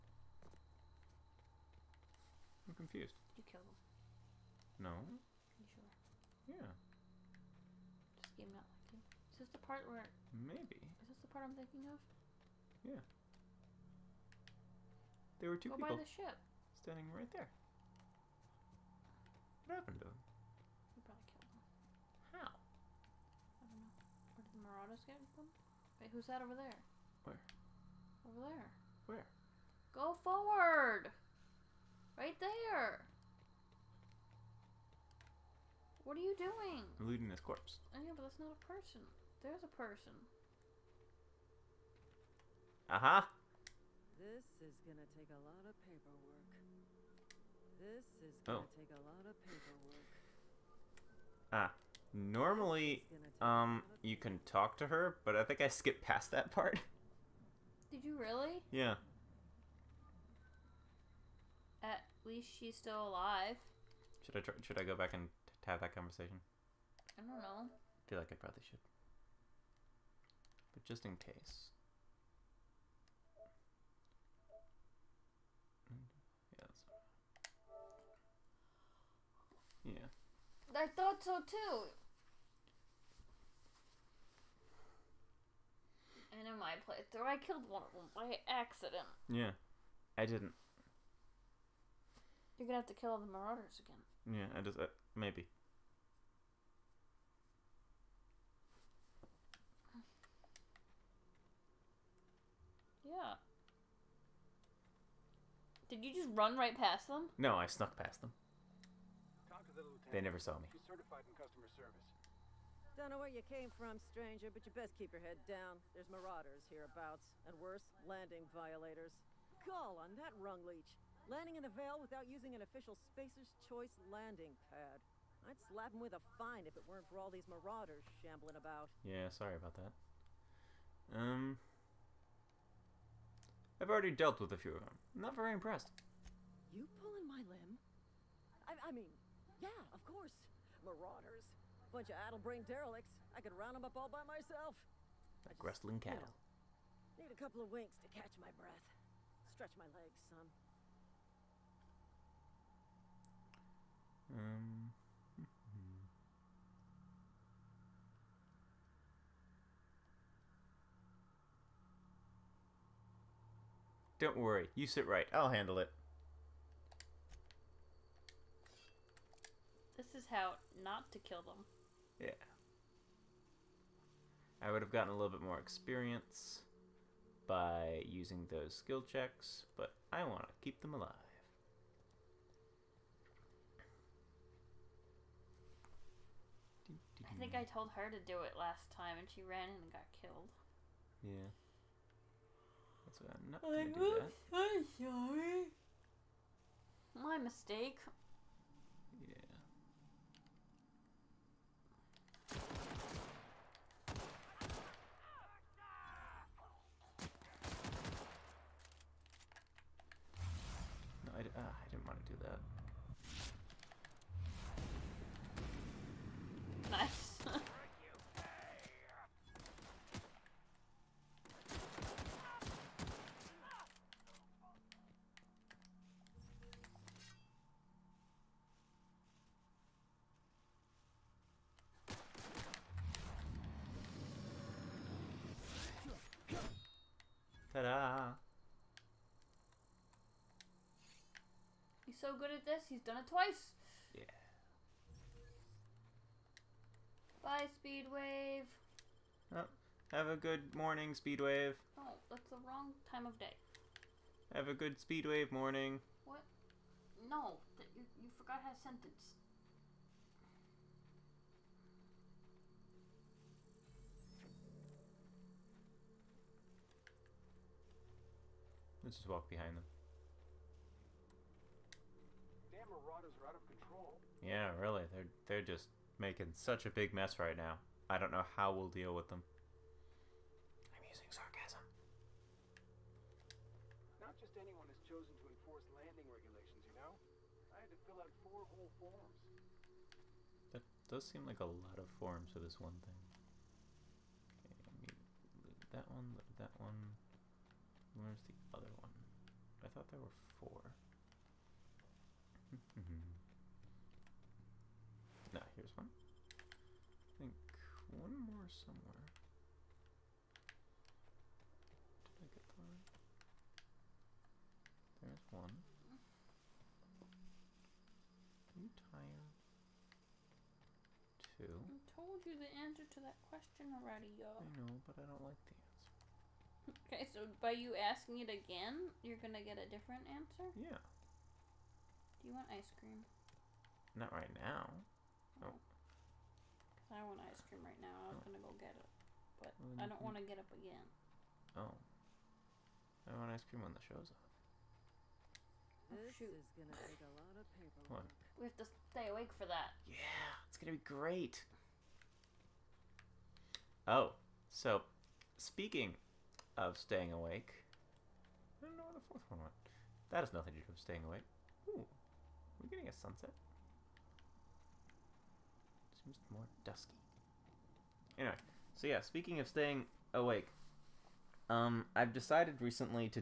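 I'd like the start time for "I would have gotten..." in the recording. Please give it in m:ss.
2:54.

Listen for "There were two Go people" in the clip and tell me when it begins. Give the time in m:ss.
0:15.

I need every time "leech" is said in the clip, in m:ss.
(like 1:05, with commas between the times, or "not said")
2:00.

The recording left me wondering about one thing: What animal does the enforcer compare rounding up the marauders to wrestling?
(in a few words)
Cattle.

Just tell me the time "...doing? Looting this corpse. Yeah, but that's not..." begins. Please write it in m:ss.
0:36.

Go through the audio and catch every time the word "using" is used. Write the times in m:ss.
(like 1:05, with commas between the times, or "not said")
2:02, 2:58, 4:41.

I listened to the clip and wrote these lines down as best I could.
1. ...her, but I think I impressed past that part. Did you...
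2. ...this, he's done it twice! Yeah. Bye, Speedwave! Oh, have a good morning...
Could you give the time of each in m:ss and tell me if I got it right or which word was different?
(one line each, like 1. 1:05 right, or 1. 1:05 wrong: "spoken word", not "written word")
1. 0:54 wrong: "skipped", not "impressed"
2. 4:02 right.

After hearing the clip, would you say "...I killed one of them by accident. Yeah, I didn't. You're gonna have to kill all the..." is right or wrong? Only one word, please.
right.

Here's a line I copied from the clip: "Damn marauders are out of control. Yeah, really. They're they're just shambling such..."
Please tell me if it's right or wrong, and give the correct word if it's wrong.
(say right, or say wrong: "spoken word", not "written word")
wrong: "making", not "shambling".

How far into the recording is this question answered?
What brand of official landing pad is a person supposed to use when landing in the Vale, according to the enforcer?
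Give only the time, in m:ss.
2:03.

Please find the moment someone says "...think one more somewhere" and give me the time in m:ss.
5:07.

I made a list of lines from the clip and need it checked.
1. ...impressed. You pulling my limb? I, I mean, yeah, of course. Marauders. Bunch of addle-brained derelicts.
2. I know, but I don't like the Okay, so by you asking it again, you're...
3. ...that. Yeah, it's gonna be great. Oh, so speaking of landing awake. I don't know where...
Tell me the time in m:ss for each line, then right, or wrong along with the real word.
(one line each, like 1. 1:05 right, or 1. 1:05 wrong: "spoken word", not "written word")
1. 2:15 right
2. 5:24 right
3. 5:49 wrong: "staying", not "landing".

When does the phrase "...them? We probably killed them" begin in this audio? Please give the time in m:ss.
0:20.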